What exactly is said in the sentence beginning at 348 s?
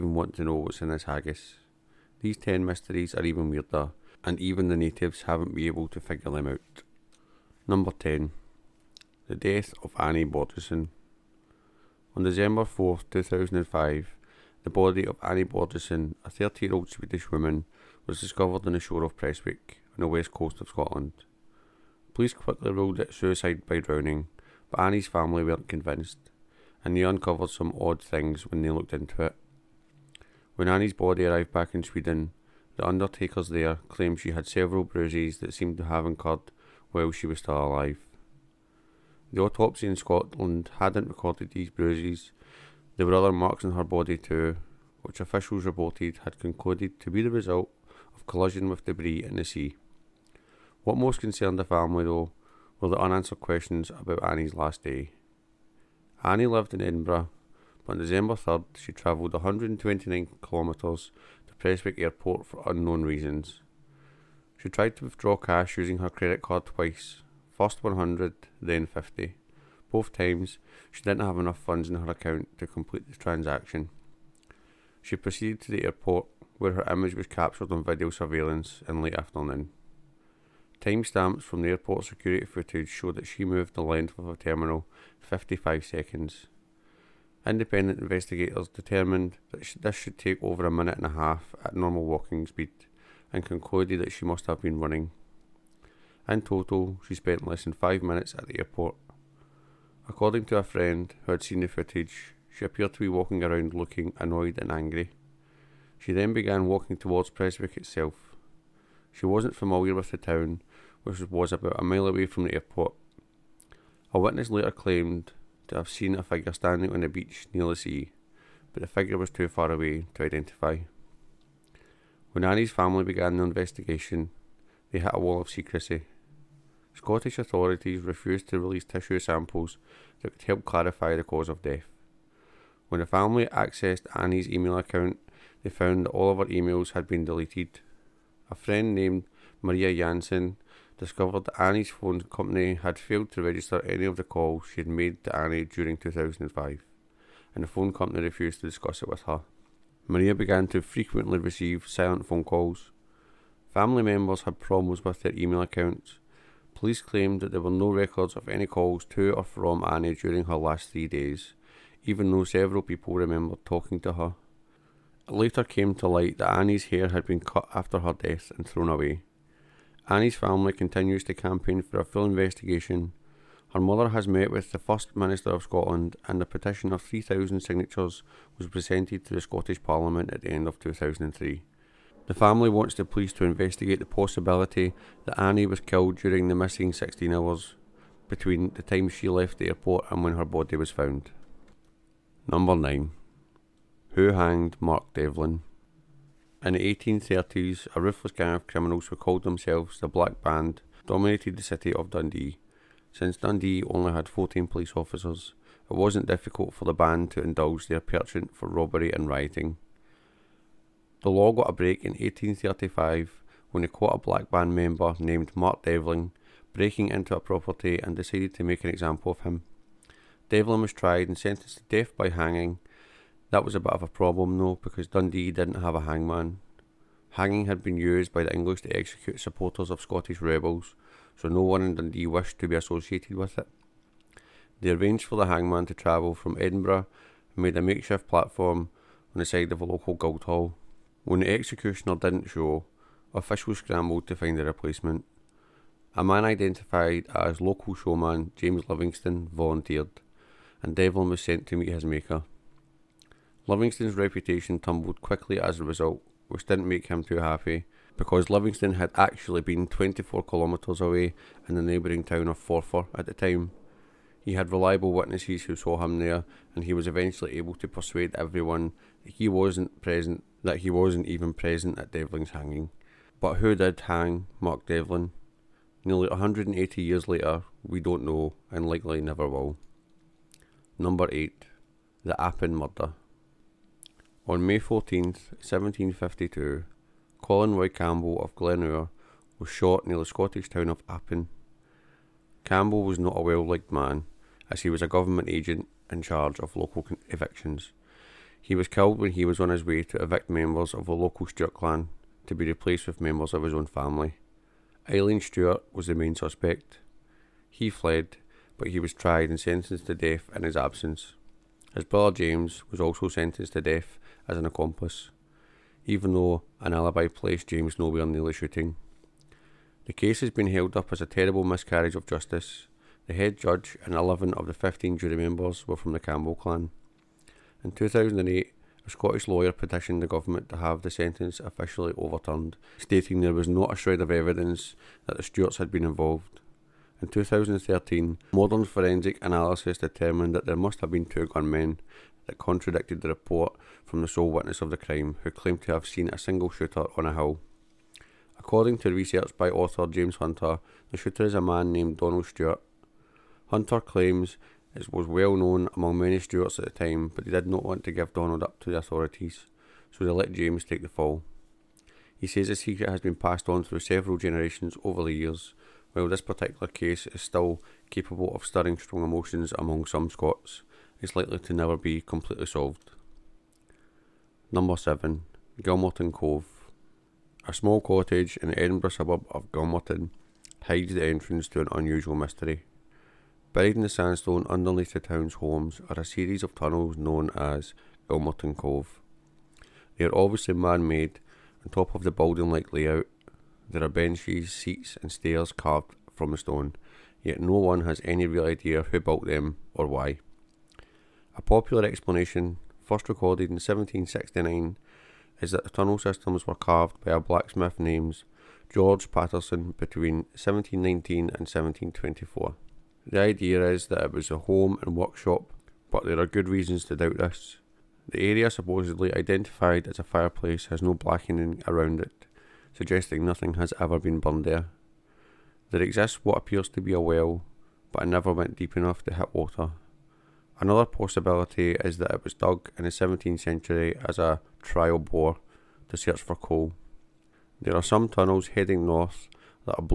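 According to research by author James Hunter, the shooter is a man named Donald Stewart.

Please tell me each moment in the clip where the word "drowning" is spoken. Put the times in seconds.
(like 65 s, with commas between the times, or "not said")
23 s.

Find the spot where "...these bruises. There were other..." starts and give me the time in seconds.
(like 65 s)
41 s.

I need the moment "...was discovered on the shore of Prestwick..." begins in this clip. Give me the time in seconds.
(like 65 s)
18 s.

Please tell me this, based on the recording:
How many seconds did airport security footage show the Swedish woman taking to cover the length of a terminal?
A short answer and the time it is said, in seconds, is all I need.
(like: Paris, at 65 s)
55, at 85 s.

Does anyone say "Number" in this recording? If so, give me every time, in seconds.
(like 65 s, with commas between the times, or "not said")
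7 s, 192 s, 280 s, 374 s.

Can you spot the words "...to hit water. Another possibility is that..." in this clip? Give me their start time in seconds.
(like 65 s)
429 s.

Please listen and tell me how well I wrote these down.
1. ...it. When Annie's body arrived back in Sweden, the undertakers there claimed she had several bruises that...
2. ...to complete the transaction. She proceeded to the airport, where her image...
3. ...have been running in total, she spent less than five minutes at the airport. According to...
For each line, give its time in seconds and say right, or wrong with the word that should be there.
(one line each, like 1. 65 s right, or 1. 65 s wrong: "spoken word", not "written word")
1. 29 s right
2. 72 s right
3. 94 s right.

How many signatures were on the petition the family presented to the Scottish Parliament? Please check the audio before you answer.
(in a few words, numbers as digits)
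3,000.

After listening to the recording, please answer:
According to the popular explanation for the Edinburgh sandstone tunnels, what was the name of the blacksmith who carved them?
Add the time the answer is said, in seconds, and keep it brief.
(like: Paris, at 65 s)
George Patterson, at 408 s.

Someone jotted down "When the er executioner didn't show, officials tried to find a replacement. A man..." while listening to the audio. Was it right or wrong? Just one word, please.
wrong.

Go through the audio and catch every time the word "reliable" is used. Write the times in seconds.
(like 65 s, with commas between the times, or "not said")
264 s.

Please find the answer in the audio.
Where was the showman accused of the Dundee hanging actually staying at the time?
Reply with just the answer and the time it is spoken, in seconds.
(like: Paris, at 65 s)
Forfar, at 262 s.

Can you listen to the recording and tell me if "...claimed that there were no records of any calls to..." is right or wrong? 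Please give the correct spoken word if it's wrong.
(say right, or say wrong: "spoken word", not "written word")
right.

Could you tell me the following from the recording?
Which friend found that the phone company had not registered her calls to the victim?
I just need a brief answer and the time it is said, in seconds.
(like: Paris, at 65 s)
Maria Jansen, at 139 s.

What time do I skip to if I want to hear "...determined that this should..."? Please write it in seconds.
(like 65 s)
88 s.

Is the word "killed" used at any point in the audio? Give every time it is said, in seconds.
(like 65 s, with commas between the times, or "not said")
185 s, 298 s.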